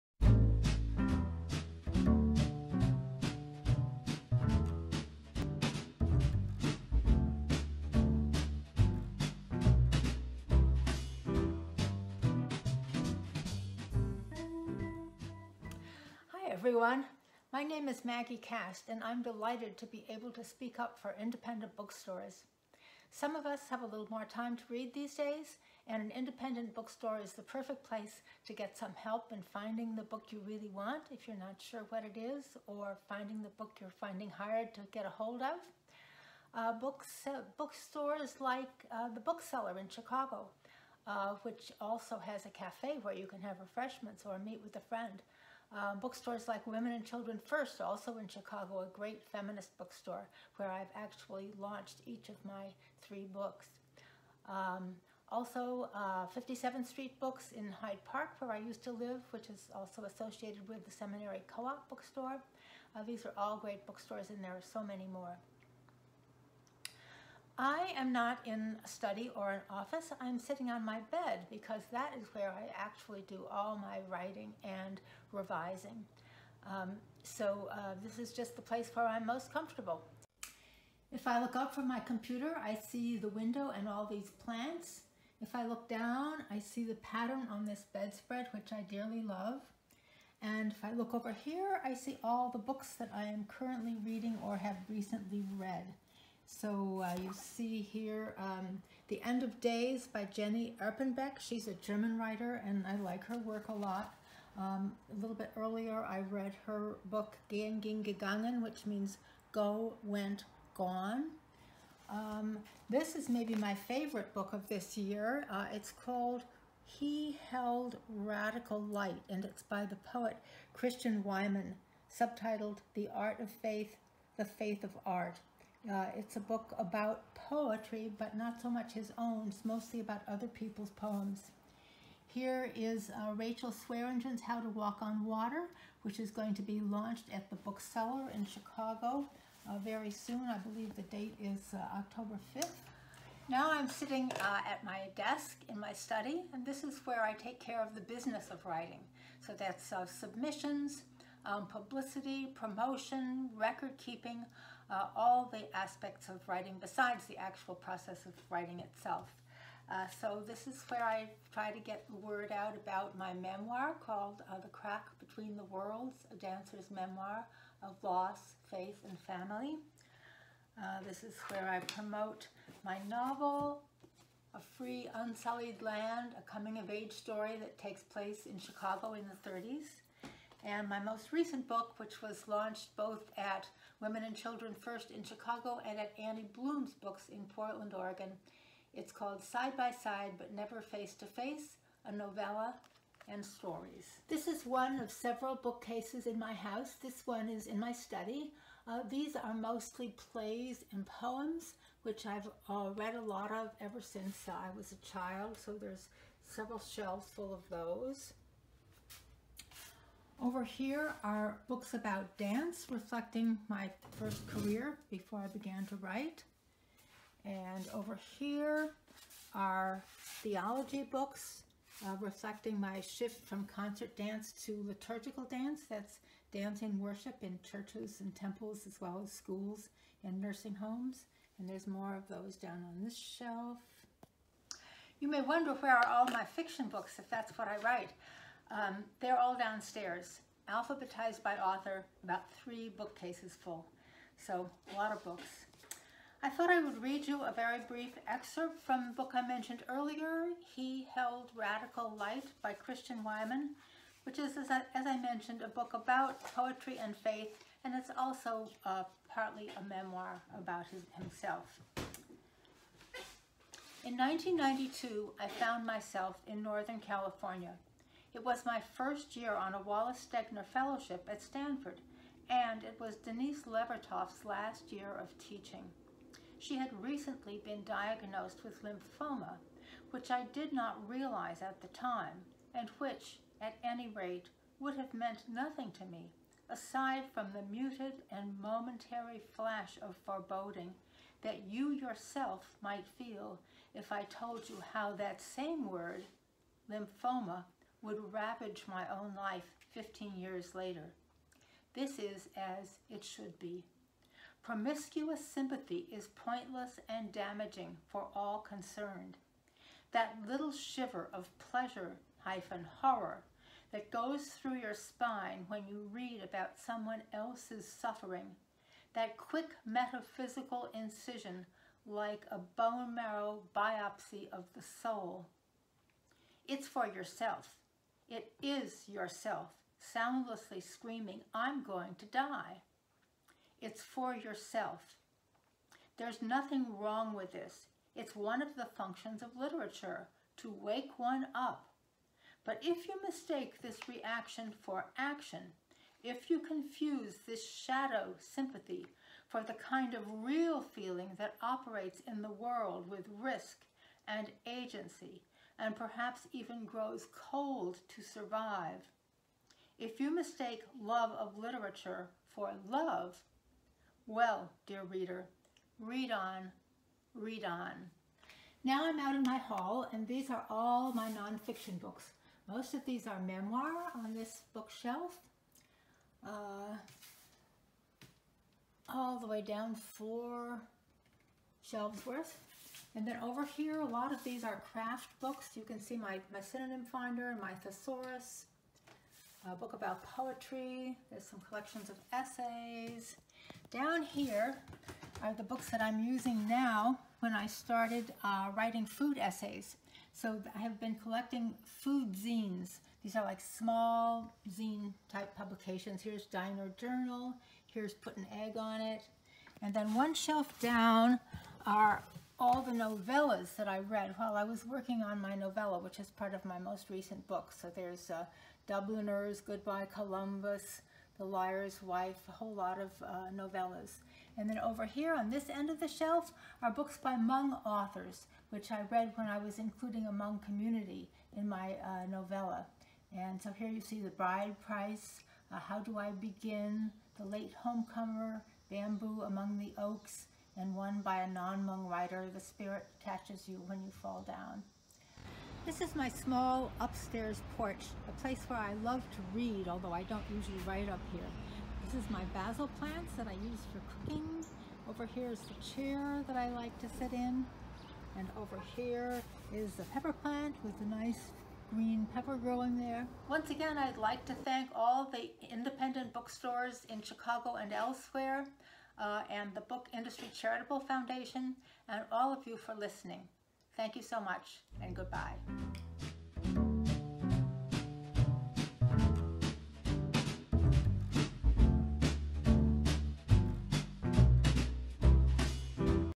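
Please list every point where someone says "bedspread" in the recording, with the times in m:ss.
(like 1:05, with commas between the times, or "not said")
1:27.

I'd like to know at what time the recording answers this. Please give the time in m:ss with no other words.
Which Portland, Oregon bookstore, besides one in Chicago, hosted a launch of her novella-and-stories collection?
3:06.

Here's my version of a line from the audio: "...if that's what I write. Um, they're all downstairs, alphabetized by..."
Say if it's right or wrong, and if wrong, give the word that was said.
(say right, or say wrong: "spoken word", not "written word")
right.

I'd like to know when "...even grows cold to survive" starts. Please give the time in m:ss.
5:56.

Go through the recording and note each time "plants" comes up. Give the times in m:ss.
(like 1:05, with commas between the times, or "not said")
1:24, 7:32, 7:40.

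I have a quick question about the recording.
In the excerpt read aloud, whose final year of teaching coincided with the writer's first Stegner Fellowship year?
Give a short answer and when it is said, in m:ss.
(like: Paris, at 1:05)
Denise Levertov, at 4:33.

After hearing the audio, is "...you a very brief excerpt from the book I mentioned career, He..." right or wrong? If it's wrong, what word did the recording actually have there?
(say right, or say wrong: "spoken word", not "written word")
wrong: "earlier", not "career".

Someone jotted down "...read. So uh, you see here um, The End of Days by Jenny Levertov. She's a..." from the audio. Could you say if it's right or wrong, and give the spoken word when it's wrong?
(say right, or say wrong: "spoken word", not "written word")
wrong: "Erpenbeck", not "Levertov".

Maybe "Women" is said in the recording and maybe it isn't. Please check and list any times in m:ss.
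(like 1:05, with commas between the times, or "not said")
0:46, 3:03.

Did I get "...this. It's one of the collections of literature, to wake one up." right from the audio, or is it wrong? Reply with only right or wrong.
wrong.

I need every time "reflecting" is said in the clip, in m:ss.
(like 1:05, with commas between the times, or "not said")
3:32, 3:42.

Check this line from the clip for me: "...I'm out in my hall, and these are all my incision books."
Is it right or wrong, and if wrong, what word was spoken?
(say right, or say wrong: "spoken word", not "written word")
wrong: "nonfiction", not "incision".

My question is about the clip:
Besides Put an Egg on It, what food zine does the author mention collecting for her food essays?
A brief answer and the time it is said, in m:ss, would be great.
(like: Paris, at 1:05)
Diner Journal, at 6:46.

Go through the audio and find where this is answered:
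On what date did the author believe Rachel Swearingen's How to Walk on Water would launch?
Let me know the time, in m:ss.
2:21.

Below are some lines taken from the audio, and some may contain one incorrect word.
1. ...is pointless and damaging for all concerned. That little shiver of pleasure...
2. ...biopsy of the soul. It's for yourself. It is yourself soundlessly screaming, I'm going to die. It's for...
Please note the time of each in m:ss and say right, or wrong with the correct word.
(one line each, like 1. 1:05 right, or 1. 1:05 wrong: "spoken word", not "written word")
1. 5:06 right
2. 5:23 right.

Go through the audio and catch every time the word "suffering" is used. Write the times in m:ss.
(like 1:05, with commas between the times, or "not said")
5:17.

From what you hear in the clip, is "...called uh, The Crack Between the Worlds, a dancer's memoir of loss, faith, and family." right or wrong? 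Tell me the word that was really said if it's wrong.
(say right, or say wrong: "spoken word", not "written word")
right.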